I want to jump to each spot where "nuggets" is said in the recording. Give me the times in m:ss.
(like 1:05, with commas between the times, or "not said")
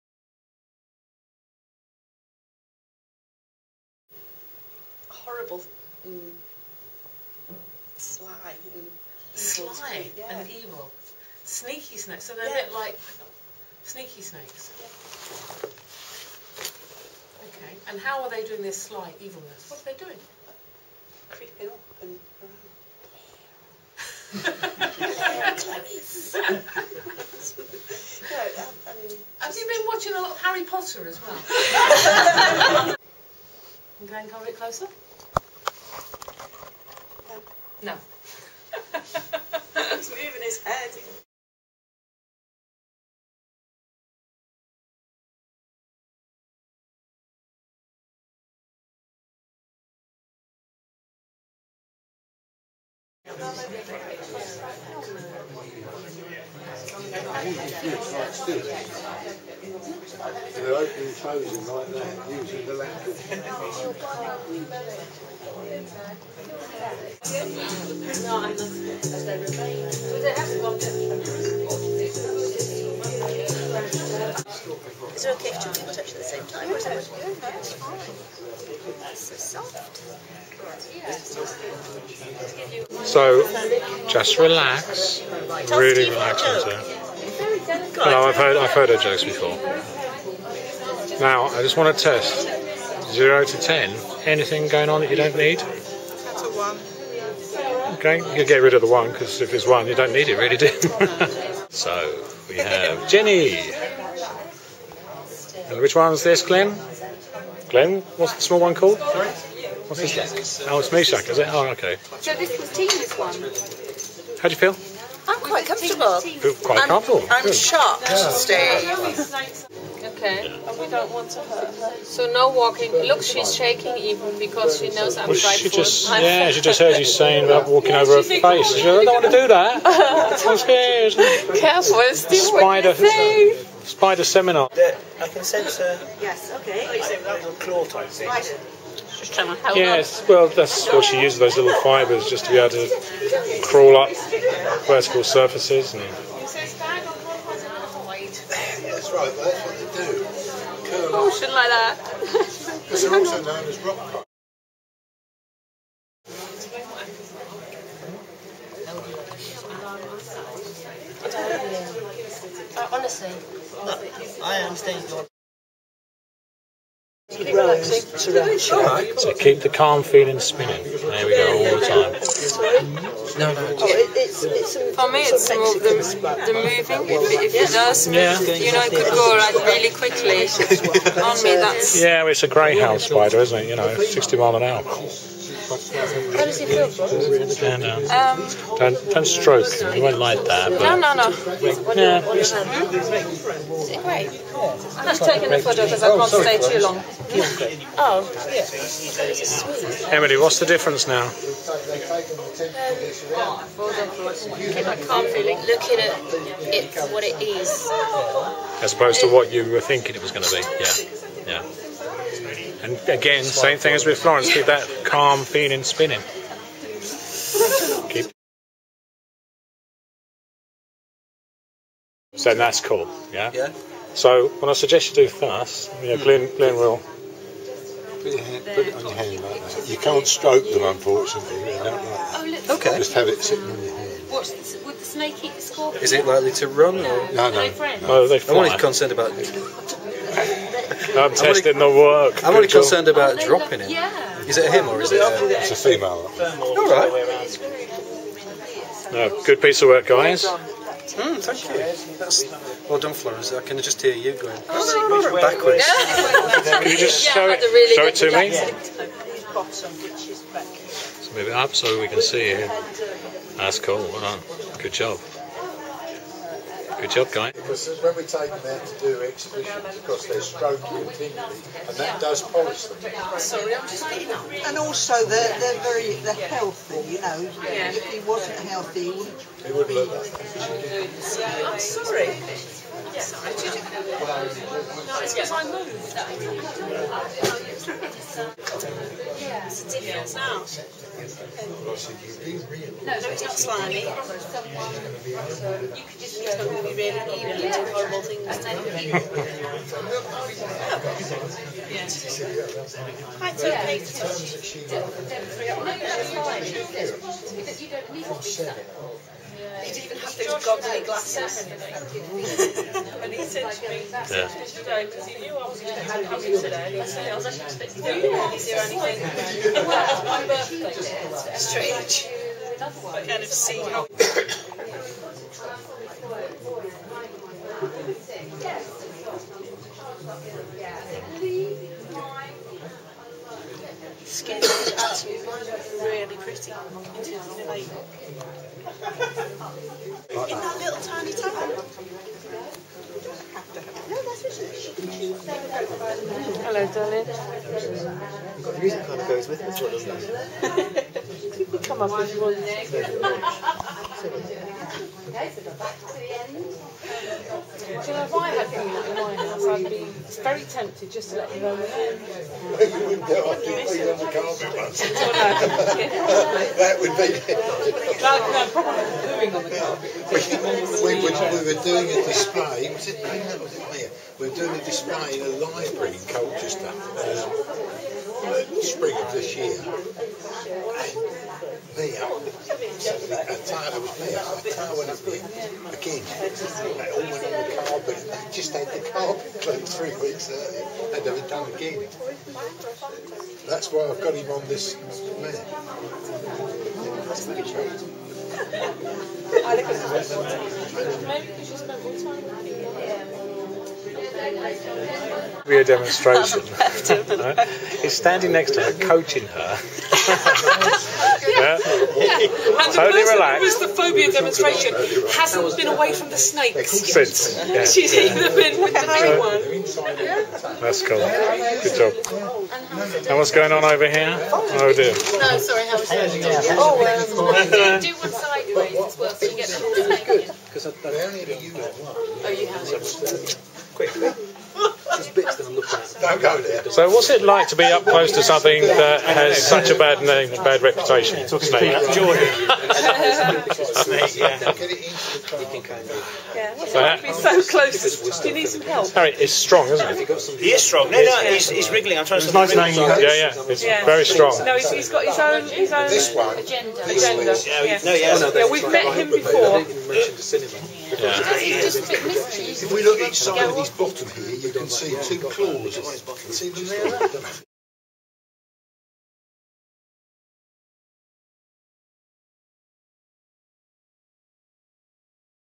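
not said.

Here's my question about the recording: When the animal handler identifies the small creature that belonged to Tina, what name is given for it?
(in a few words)
Meshack.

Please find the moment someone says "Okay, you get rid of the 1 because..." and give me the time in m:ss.
1:37.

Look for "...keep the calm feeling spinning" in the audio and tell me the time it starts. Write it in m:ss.
2:49.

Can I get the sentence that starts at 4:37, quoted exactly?
If he wasn't healthy, he wouldn't.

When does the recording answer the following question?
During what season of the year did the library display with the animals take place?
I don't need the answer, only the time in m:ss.
6:18.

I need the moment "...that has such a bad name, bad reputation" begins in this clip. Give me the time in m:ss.
7:18.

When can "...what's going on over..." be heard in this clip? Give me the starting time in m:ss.
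7:03.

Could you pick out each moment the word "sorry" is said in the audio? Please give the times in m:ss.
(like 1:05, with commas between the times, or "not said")
4:33, 4:41, 7:05.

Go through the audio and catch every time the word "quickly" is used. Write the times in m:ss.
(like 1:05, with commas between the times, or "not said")
2:59, 7:13.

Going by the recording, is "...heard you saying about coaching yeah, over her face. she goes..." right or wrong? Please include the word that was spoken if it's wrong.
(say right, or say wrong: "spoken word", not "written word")
wrong: "walking", not "coaching".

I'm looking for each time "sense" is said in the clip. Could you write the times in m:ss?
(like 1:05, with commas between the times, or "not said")
2:15.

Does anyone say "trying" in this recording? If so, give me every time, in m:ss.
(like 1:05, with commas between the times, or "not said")
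2:19, 7:32.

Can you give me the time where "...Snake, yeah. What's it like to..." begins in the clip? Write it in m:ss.
7:24.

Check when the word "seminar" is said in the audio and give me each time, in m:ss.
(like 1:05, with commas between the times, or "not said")
2:14.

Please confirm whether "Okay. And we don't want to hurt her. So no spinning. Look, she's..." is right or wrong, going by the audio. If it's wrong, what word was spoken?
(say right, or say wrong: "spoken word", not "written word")
wrong: "walking", not "spinning".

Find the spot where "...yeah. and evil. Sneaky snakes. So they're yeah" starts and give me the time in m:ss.
0:10.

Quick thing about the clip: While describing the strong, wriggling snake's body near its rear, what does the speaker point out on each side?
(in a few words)
two claws.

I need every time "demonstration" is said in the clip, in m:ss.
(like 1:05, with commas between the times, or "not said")
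6:45, 6:54.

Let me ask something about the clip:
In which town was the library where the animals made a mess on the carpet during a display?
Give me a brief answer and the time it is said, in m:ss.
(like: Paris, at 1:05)
Colchester, at 6:16.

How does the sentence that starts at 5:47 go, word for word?
Got the music club goes with this doesn't it?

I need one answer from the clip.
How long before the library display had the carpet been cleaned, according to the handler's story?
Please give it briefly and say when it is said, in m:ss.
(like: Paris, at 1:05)
3 weeks, at 6:29.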